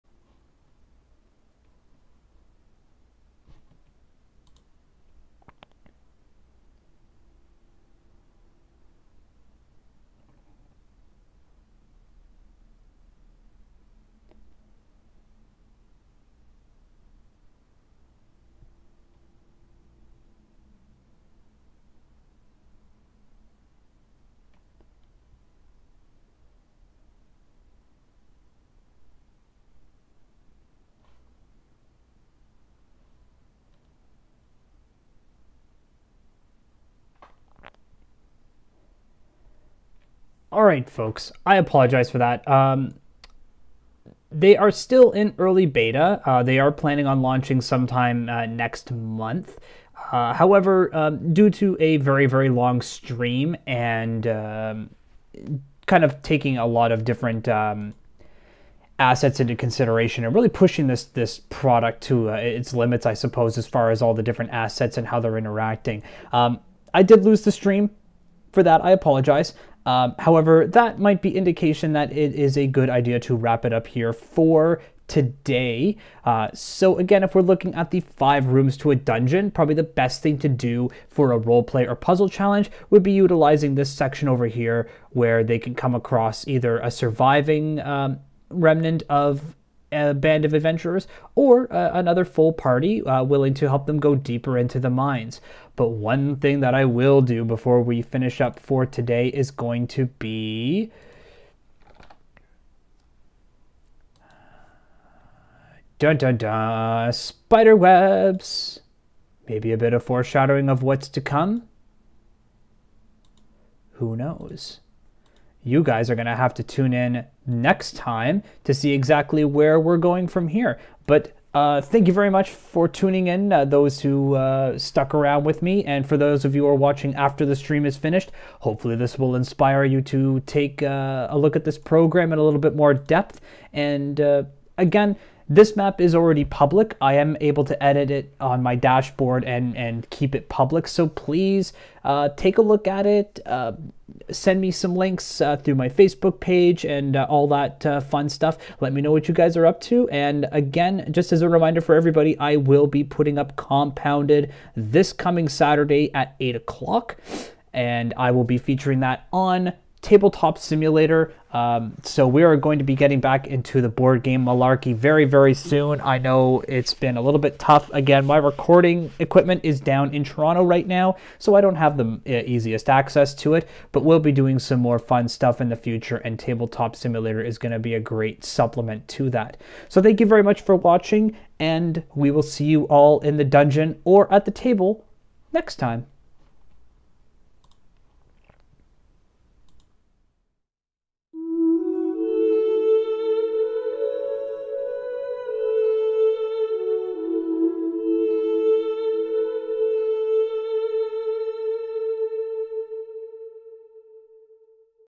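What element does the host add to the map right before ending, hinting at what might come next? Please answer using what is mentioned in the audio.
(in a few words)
Spider webs.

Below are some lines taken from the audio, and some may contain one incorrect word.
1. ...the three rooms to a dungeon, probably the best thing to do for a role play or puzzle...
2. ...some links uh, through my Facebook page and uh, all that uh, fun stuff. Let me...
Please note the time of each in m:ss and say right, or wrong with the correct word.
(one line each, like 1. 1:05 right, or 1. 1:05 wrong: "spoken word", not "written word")
1. 1:17 wrong: "five", not "three"
2. 2:24 right.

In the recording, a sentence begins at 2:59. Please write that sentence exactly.
So thank you very much for watching, and we will see you all in the dungeon or at the table next time.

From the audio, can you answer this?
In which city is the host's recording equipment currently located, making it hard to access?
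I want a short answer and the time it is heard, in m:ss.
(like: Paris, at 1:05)
Toronto, at 2:50.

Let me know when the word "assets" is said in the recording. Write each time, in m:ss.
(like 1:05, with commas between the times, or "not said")
0:58, 1:04.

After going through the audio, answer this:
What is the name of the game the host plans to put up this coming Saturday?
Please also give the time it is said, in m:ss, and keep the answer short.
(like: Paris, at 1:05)
Compounded, at 2:33.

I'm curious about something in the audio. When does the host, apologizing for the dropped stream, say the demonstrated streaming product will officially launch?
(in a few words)
next month.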